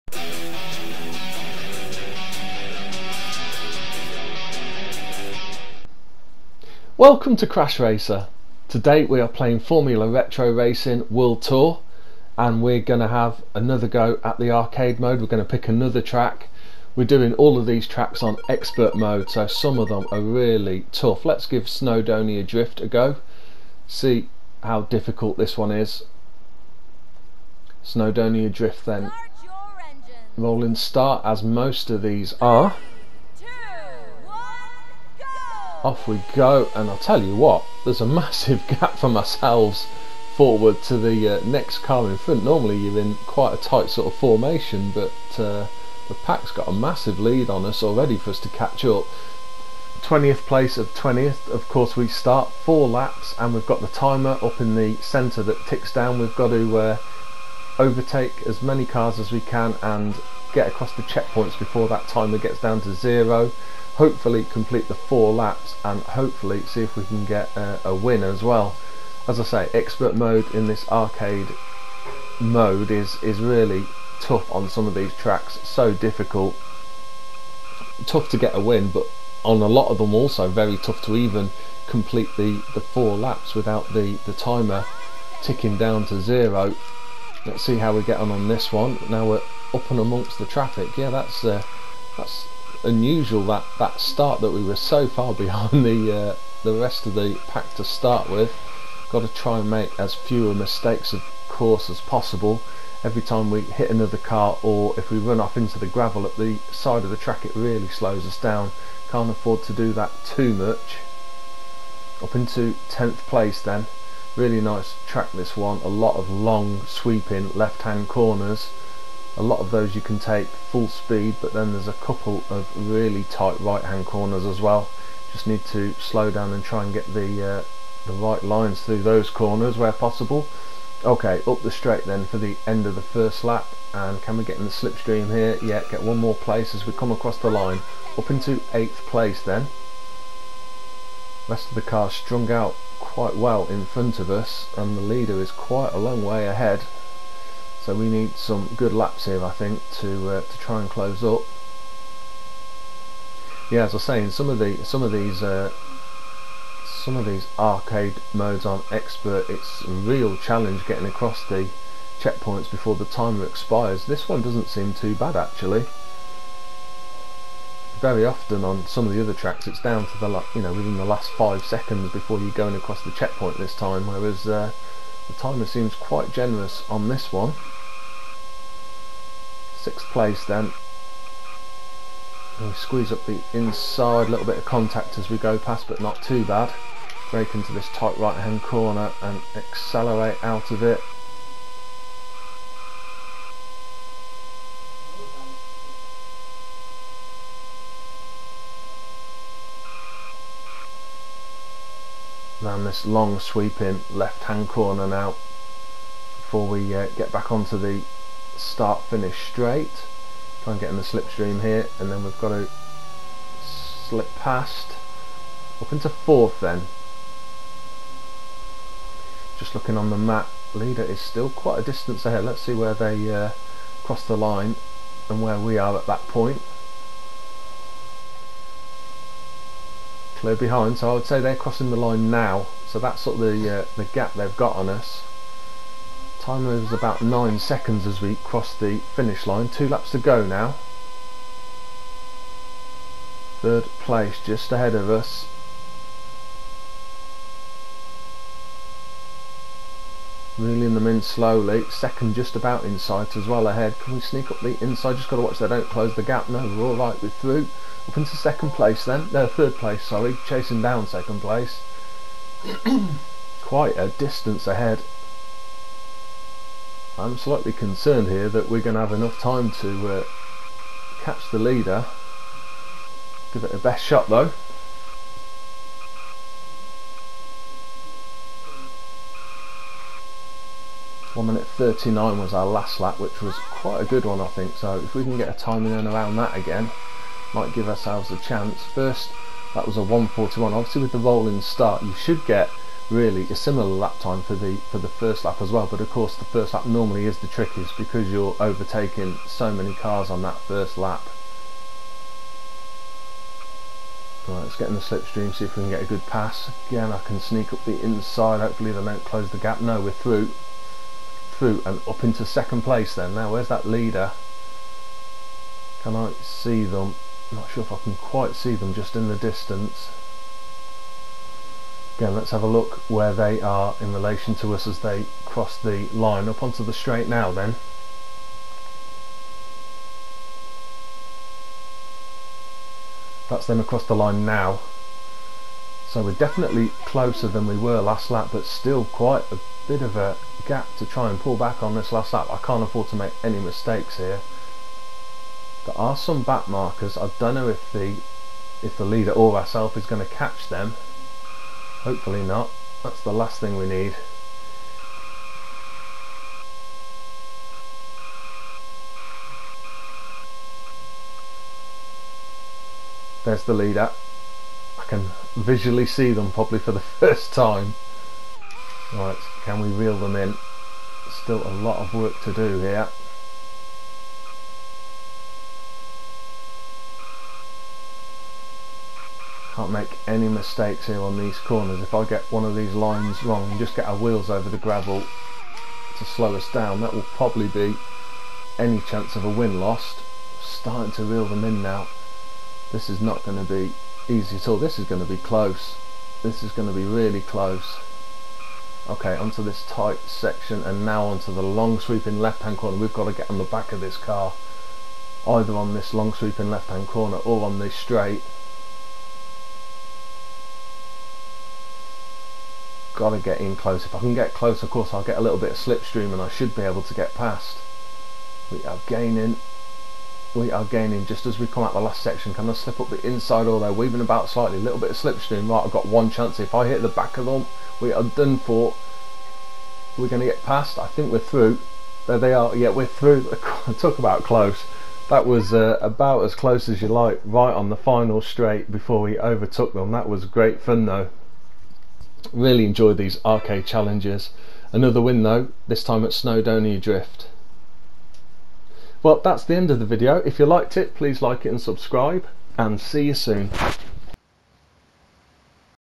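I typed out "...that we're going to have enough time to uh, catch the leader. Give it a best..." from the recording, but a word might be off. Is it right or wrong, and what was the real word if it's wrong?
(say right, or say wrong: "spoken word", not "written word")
right.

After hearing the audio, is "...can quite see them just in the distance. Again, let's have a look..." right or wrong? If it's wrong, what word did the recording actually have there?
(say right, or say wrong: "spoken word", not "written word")
right.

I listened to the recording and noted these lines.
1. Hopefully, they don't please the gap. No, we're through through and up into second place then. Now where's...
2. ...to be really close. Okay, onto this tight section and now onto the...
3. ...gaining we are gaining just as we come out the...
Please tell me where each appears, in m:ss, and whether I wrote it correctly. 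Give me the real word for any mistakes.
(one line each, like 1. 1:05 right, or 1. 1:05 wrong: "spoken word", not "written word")
1. 5:08 wrong: "close", not "please"
2. 6:36 right
3. 6:59 right.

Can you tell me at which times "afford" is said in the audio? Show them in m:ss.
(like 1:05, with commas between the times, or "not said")
1:49, 5:42.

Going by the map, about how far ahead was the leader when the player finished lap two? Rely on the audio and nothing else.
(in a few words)
9 seconds.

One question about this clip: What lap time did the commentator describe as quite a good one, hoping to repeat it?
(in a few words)
1 minute 39.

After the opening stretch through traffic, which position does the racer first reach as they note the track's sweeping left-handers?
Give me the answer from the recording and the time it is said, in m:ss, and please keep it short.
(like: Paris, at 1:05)
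10th, at 1:52.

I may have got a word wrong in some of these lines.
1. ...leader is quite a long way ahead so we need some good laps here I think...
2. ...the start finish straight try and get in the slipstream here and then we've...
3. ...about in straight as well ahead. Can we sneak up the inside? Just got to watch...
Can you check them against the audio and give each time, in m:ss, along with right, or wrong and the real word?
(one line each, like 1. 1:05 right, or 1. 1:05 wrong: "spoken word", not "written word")
1. 2:25 right
2. 3:27 right
3. 4:12 wrong: "sight", not "straight".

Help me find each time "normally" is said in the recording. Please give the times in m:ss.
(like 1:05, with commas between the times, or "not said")
0:42, 4:56.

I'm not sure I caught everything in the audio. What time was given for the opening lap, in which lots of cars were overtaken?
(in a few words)
1:41.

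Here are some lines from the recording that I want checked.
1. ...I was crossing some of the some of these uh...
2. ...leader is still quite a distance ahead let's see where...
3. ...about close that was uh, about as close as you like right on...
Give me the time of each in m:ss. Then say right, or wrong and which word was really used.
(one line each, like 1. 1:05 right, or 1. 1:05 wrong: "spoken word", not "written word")
1. 2:33 wrong: "saying", not "crossing"
2. 3:40 right
3. 7:14 right.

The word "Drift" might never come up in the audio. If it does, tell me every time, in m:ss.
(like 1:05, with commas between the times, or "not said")
0:22, 0:28, 7:26.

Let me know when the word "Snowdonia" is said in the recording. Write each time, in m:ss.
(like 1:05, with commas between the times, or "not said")
0:21, 0:27, 7:26.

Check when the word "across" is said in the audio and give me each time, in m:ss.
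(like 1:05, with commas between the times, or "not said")
1:00, 2:17, 2:41, 2:52, 5:33.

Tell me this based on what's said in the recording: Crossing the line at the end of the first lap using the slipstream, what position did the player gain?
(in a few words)
8th.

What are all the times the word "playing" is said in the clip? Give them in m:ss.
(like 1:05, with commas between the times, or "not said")
0:09.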